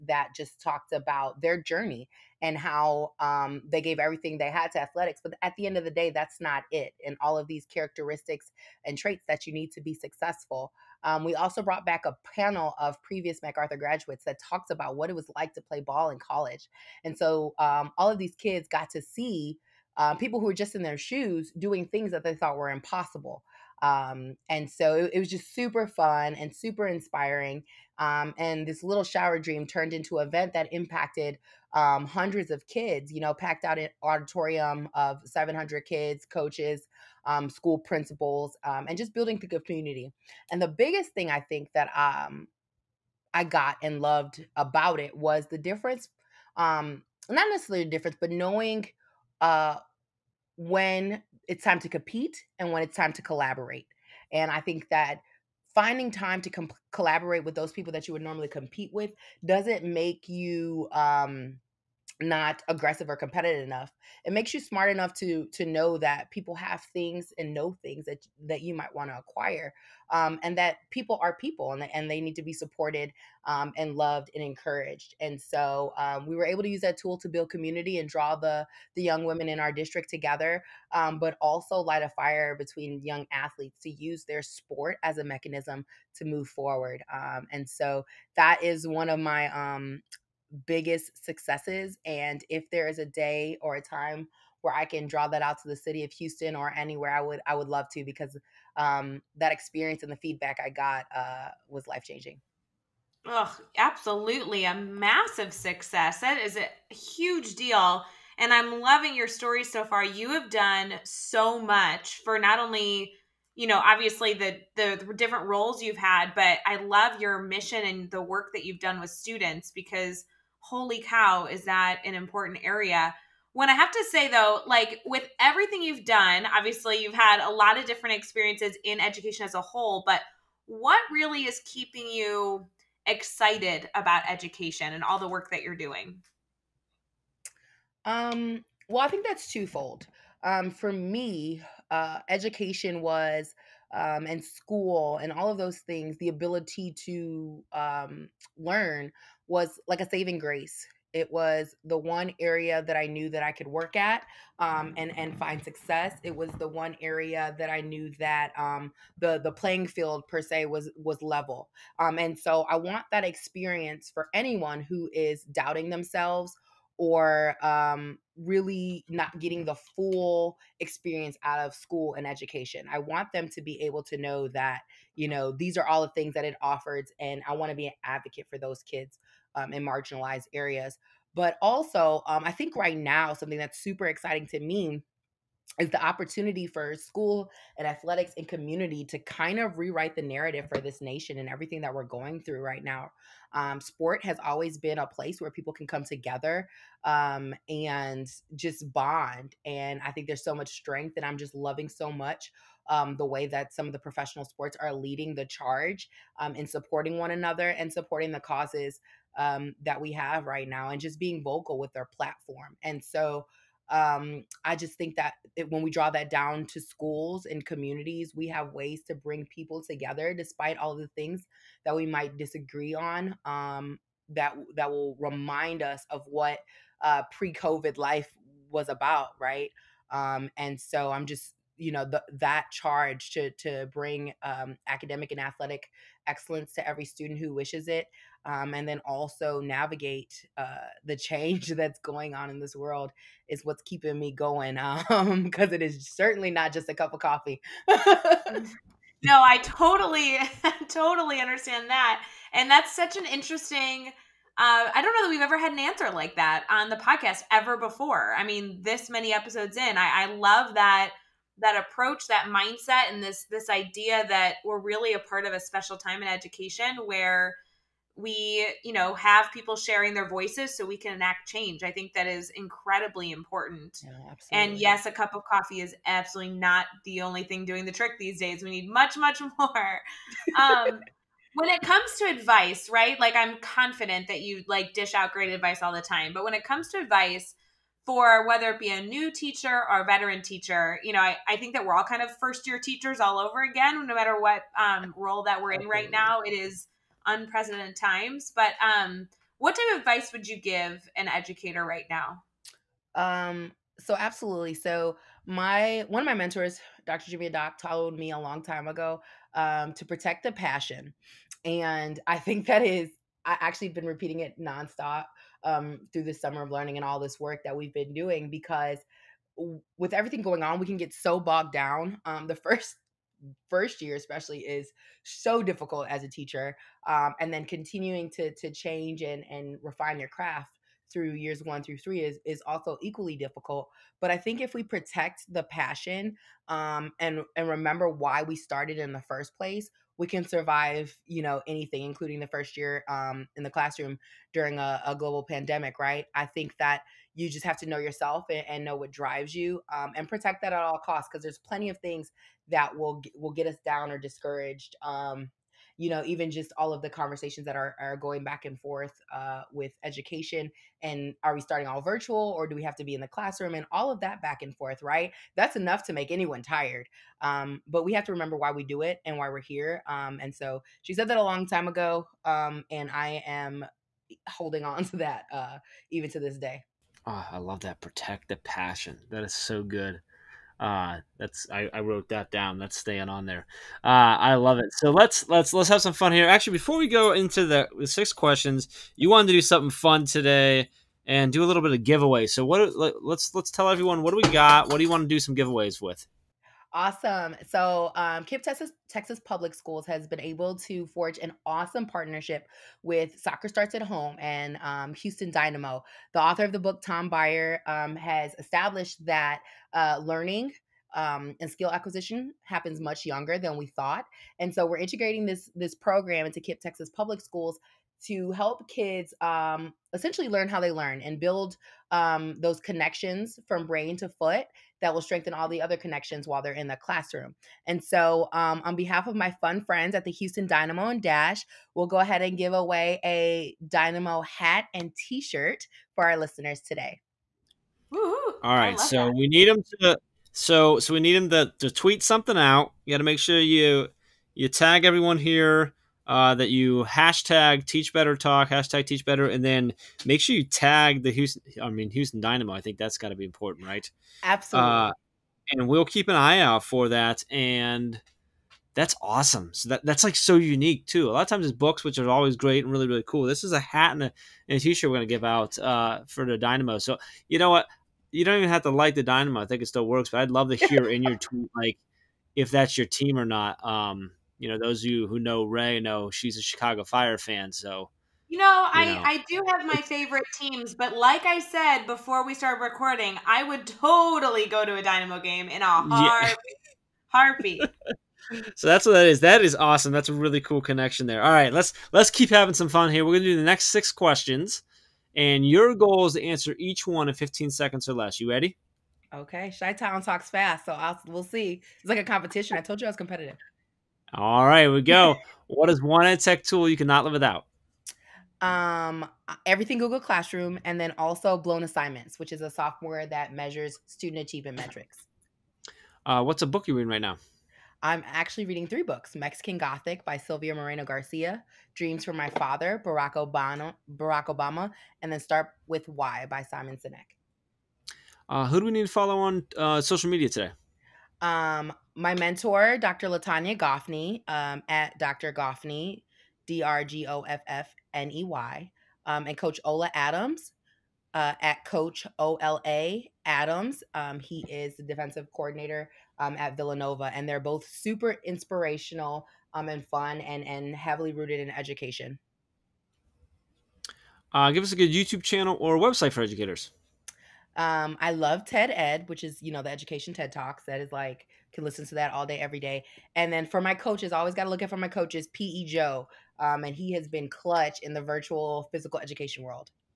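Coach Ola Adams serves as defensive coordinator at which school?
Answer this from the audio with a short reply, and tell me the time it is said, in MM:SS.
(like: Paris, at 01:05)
Villanova, at 09:06.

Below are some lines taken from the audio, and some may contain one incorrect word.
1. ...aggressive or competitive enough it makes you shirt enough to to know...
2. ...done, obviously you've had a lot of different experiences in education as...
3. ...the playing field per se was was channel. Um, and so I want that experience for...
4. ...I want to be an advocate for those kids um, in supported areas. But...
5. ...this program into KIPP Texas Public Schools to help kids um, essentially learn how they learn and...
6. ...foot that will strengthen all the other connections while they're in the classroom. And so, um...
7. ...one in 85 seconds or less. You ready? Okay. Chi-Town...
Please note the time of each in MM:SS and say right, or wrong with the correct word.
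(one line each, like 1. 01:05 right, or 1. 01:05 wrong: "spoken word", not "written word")
1. 01:02 wrong: "smart", not "shirt"
2. 02:06 right
3. 02:39 wrong: "level", not "channel"
4. 02:57 wrong: "marginalized", not "supported"
5. 06:55 right
6. 07:04 right
7. 08:17 wrong: "15", not "85".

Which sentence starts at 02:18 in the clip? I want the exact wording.
Um, well, I think that's twofold.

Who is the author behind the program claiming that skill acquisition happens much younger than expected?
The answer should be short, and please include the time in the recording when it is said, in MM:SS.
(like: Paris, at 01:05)
Tom Byer, at 06:47.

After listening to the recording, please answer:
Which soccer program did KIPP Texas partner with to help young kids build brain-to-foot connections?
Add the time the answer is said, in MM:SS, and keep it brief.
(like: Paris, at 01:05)
Soccer Starts at Home, at 06:43.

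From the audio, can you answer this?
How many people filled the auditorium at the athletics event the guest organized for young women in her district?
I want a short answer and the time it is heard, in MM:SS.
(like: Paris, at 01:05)
700, at 00:35.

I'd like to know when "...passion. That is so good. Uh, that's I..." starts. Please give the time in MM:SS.
06:18.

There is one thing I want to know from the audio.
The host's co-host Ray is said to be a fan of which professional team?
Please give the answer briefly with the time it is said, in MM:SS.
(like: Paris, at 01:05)
Chicago Fire, at 07:56.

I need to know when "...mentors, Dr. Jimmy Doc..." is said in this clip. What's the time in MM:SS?
05:06.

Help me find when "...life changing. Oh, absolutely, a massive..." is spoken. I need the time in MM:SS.
01:41.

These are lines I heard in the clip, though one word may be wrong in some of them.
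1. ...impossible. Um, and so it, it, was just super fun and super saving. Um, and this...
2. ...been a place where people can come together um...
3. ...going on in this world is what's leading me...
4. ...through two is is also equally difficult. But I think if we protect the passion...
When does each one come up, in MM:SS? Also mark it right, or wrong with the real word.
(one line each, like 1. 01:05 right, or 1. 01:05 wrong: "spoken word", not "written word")
1. 00:22 wrong: "inspiring", not "saving"
2. 03:14 right
3. 04:02 wrong: "keeping", not "leading"
4. 05:31 wrong: "three", not "two".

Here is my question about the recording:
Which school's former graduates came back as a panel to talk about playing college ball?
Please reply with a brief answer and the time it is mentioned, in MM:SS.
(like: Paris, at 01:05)
MacArthur, at 00:13.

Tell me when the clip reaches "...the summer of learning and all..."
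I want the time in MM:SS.
05:16.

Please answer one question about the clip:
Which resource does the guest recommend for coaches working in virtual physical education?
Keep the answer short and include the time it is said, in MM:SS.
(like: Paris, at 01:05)
PE Joe, at 09:25.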